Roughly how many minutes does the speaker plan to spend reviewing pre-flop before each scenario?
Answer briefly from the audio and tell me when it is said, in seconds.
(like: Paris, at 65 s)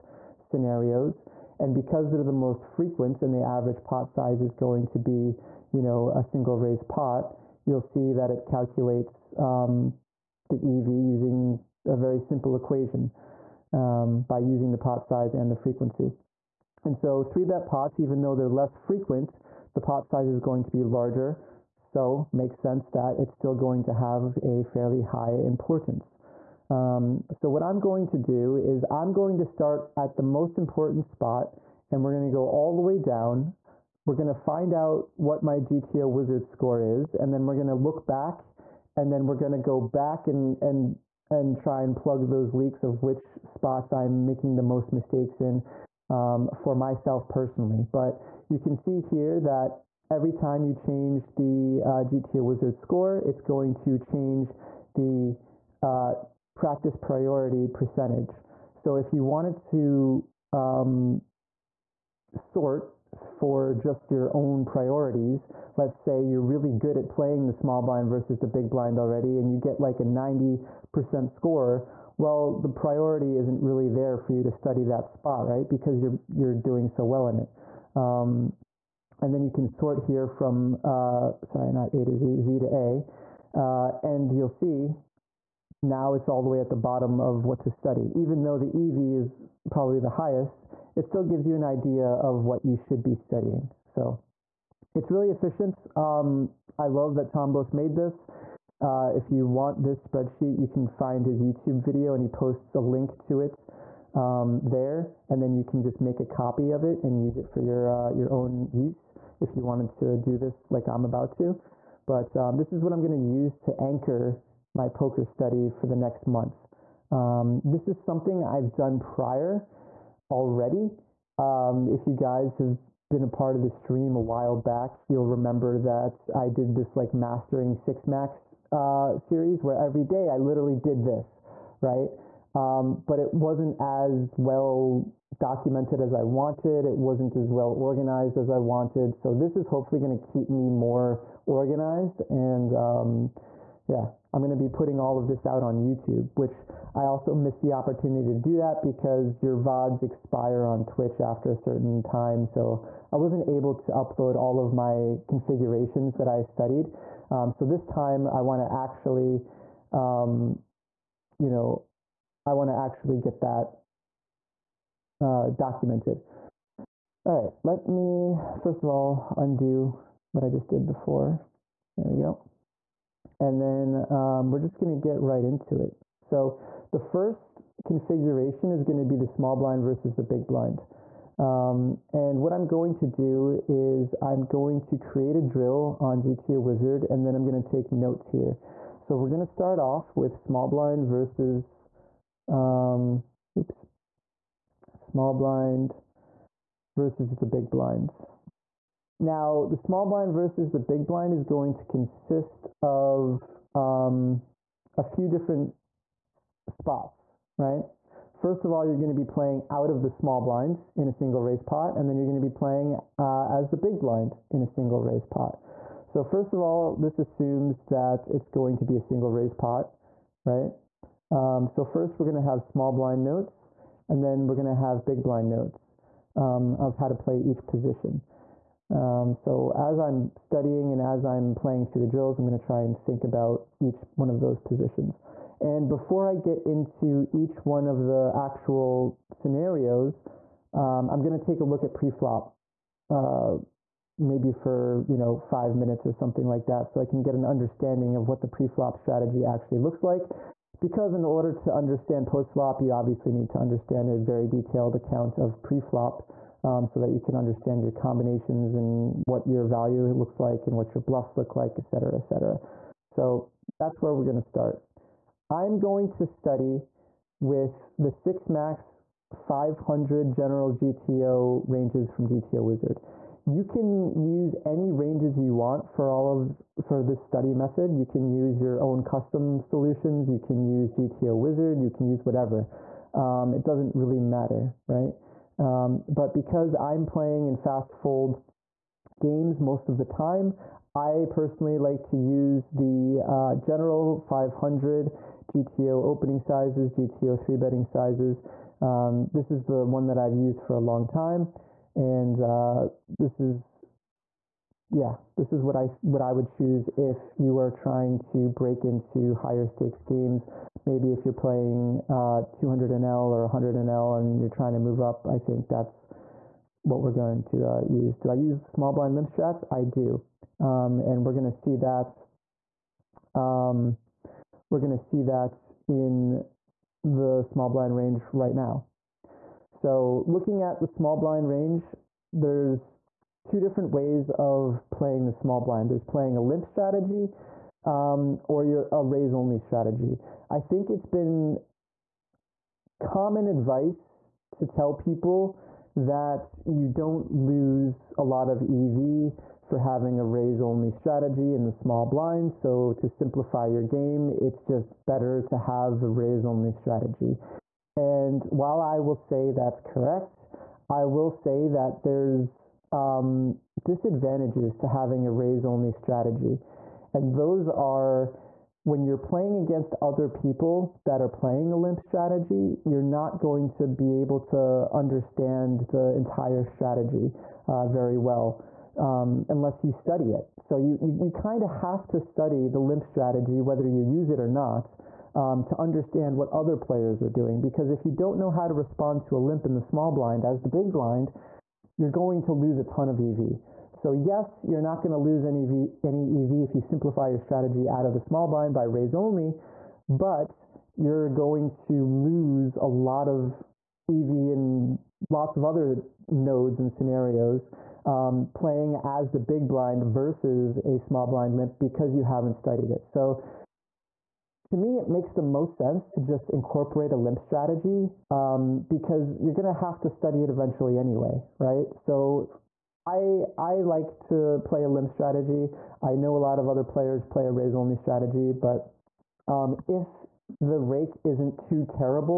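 5, at 245 s.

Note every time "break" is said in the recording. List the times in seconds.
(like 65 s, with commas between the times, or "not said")
308 s.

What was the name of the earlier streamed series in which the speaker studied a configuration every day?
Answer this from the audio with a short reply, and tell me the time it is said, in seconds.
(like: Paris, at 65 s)
mastering six max, at 127 s.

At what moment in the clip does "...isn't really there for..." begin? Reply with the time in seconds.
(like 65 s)
73 s.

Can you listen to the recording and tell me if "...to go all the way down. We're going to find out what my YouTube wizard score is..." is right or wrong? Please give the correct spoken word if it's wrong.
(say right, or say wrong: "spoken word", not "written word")
wrong: "GTO", not "YouTube".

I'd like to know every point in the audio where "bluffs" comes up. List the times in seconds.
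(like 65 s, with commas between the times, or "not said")
261 s.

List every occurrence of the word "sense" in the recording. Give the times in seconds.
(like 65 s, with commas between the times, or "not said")
22 s, 415 s.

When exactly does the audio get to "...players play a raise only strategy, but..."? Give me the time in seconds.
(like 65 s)
426 s.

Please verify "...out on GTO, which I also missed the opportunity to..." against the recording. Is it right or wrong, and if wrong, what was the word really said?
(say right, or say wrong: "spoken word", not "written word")
wrong: "YouTube", not "GTO".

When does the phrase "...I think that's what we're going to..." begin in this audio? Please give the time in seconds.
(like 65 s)
315 s.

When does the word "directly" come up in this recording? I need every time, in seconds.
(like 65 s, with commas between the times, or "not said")
not said.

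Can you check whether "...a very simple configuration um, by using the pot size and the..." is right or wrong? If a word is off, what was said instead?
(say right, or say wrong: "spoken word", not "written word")
wrong: "equation", not "configuration".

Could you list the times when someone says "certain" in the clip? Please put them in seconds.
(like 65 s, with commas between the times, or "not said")
151 s.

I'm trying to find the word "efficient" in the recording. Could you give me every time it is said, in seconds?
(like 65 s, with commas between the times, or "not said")
95 s.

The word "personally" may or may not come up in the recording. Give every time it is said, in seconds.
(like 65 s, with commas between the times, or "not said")
47 s, 291 s.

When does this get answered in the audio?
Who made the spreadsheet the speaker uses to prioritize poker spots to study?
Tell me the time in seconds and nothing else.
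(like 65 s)
97 s.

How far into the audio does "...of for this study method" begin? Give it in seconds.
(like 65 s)
276 s.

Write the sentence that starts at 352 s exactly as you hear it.
So, to simplify your game, it's just better to have a raise only strategy.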